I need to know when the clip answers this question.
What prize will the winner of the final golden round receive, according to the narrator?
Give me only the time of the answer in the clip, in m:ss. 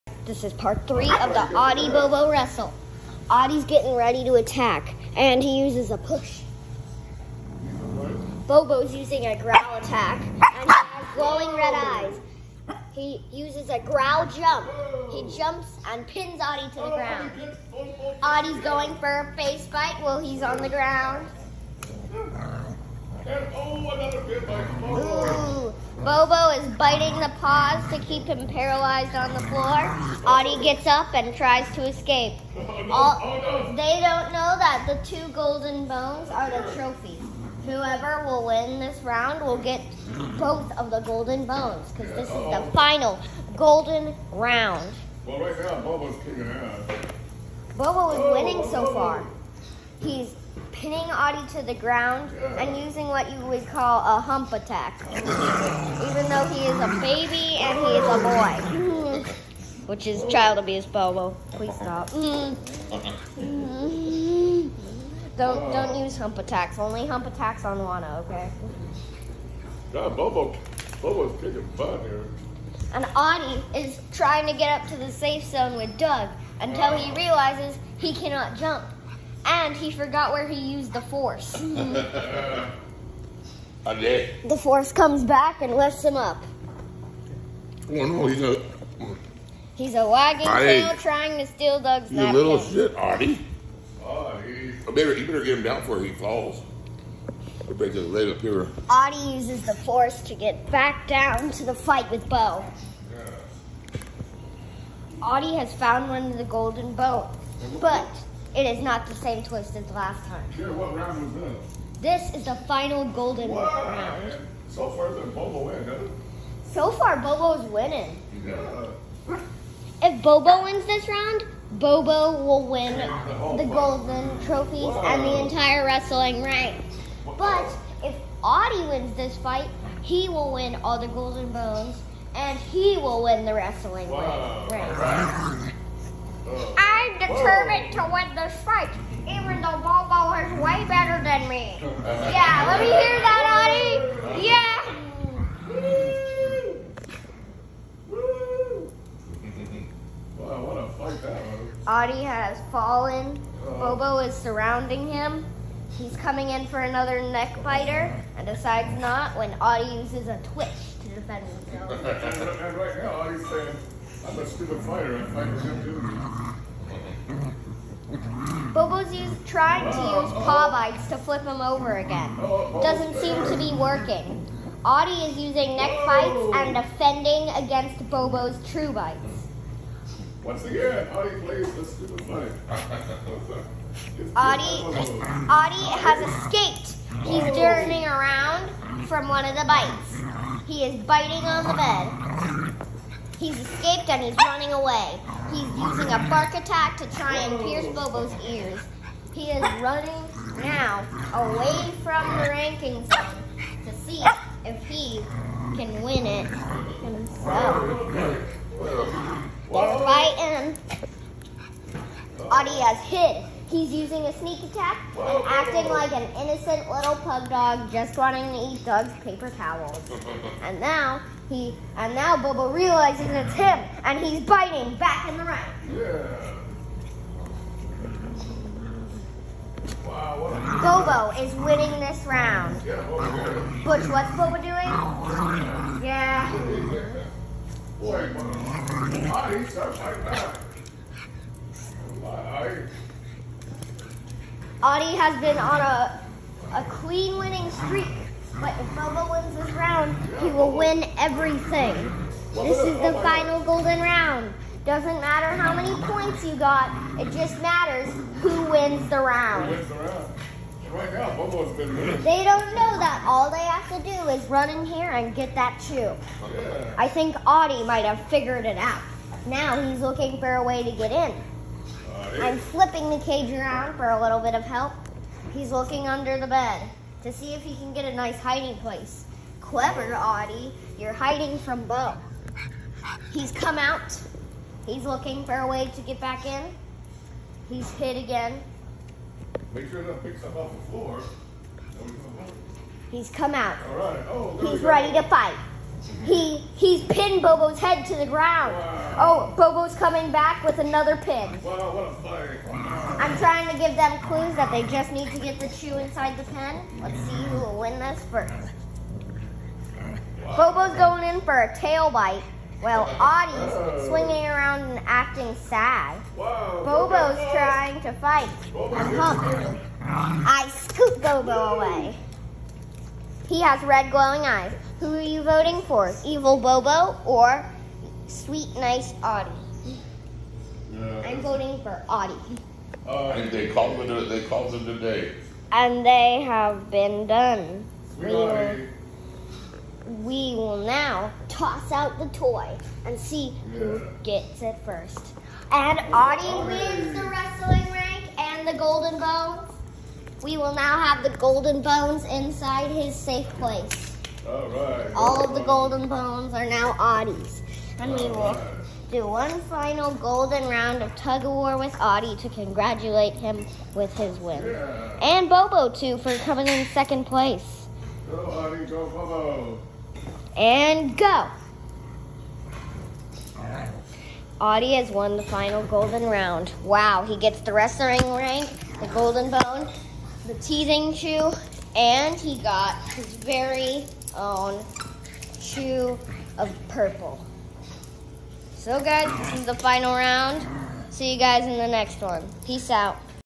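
0:35.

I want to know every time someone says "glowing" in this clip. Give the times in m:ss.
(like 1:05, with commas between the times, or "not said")
0:11, 5:24.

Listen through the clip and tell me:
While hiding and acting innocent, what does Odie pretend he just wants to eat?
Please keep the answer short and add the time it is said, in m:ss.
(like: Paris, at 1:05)
Doug's paper towels, at 3:38.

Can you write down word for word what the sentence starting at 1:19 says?
And he forgot where he used the force.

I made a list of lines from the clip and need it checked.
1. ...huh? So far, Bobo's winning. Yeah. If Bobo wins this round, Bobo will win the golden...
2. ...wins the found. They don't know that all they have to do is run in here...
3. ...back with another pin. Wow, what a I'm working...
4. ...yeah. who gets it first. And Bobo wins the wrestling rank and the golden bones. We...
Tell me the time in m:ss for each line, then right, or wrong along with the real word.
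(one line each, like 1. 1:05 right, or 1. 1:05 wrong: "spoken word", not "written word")
1. 1:55 right
2. 4:18 wrong: "round", not "found"
3. 5:00 wrong: "trying", not "working"
4. 5:43 wrong: "Odie", not "Bobo".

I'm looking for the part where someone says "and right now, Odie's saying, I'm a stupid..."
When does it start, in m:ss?
2:42.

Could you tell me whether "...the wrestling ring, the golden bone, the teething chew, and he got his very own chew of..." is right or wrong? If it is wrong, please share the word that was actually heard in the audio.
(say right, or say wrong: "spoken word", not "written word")
right.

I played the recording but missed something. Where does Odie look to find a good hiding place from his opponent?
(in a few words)
under the bed.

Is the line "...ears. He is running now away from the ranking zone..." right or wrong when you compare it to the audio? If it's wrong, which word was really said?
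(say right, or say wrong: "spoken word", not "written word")
right.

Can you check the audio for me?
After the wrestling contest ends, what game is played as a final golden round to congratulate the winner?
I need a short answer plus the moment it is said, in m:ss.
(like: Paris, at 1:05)
tug of war, at 6:01.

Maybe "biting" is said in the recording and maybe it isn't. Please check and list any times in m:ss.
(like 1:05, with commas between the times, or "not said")
0:26, 3:11, 3:44.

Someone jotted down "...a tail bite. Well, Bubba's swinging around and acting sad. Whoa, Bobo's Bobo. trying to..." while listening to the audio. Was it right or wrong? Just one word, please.
wrong.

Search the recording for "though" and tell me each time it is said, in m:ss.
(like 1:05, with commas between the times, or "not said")
0:56, 2:19.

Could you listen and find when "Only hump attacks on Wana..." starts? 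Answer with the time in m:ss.
1:06.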